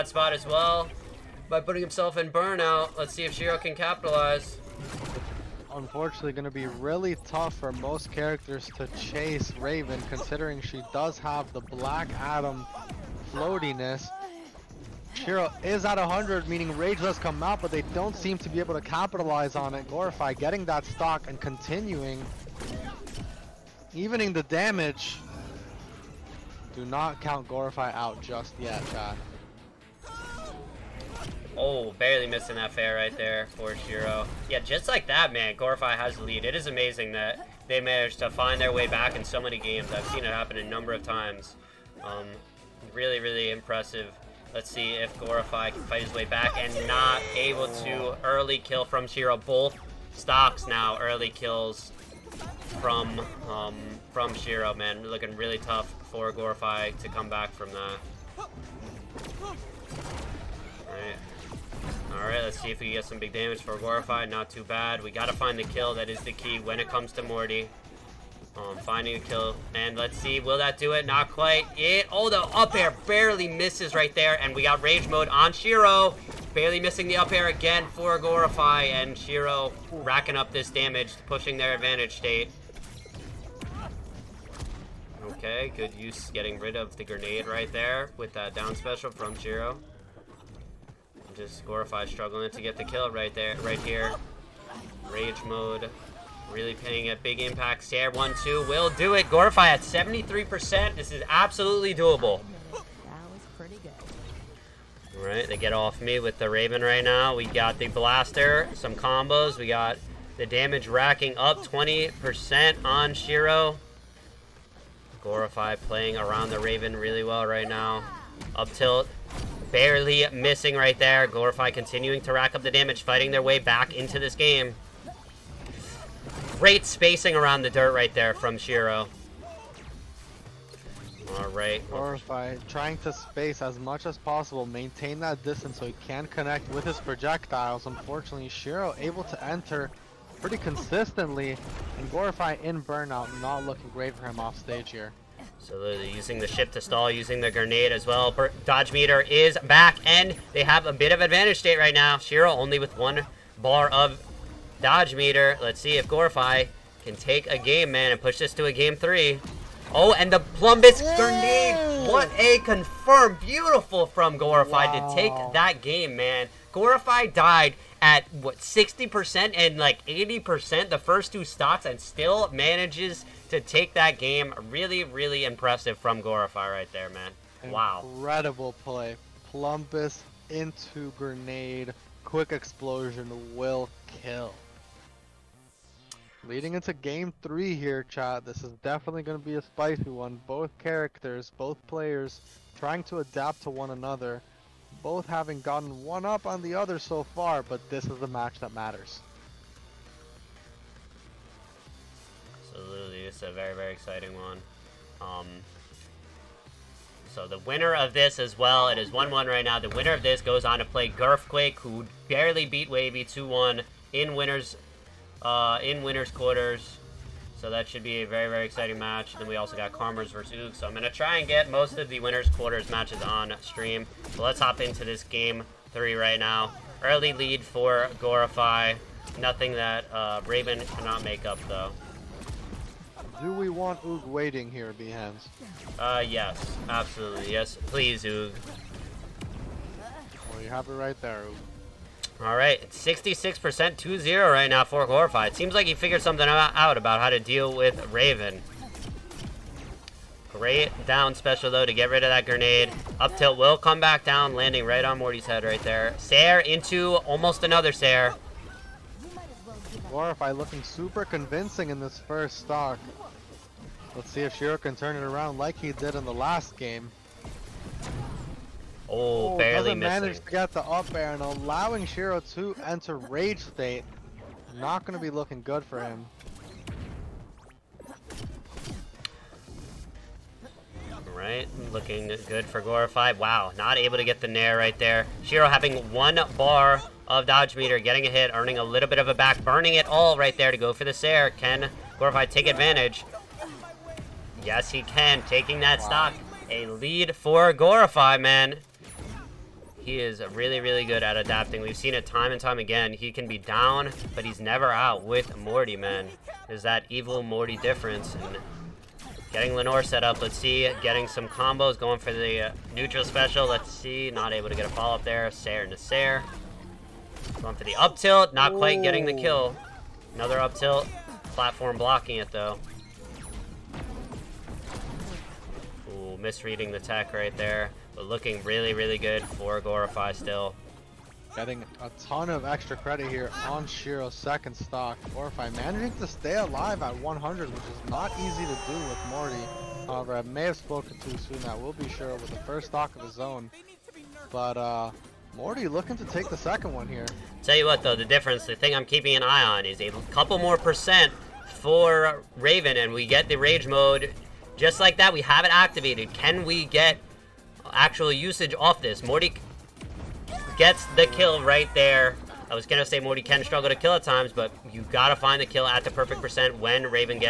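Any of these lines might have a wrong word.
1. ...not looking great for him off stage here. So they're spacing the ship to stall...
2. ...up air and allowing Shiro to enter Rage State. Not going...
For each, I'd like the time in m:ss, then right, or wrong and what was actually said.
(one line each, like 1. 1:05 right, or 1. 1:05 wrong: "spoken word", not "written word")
1. 2:23 wrong: "using", not "spacing"
2. 4:30 right.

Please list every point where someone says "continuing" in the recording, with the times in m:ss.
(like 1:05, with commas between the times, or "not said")
0:21, 2:01.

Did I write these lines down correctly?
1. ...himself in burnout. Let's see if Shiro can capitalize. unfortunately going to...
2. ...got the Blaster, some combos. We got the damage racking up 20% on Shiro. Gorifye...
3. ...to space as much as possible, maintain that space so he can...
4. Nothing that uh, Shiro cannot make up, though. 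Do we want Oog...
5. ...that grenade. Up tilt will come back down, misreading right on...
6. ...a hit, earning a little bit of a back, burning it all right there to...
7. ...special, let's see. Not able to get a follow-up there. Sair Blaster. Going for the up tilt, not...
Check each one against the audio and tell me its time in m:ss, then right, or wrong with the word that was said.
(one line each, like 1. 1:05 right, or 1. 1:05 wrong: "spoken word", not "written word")
1. 0:01 right
2. 1:47 right
3. 2:12 wrong: "distance", not "space"
4. 3:49 wrong: "Raven", not "Shiro"
5. 4:12 wrong: "landing", not "misreading"
6. 4:48 right
7. 5:13 wrong: "Nasser", not "Blaster".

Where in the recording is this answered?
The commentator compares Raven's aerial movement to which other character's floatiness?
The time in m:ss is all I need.
0:11.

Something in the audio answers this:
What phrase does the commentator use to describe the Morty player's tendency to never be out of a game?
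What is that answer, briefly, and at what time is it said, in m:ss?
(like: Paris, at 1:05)
evil Morty difference, at 5:07.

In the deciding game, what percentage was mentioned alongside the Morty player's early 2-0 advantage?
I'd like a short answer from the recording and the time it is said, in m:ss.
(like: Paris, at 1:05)
66%, at 4:03.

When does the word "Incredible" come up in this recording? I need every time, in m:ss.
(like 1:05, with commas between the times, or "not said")
2:58.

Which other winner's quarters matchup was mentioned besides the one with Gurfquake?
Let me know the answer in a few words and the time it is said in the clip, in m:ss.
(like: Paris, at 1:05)
Karmers versus Oog, at 3:39.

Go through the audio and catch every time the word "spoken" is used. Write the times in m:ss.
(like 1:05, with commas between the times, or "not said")
5:40.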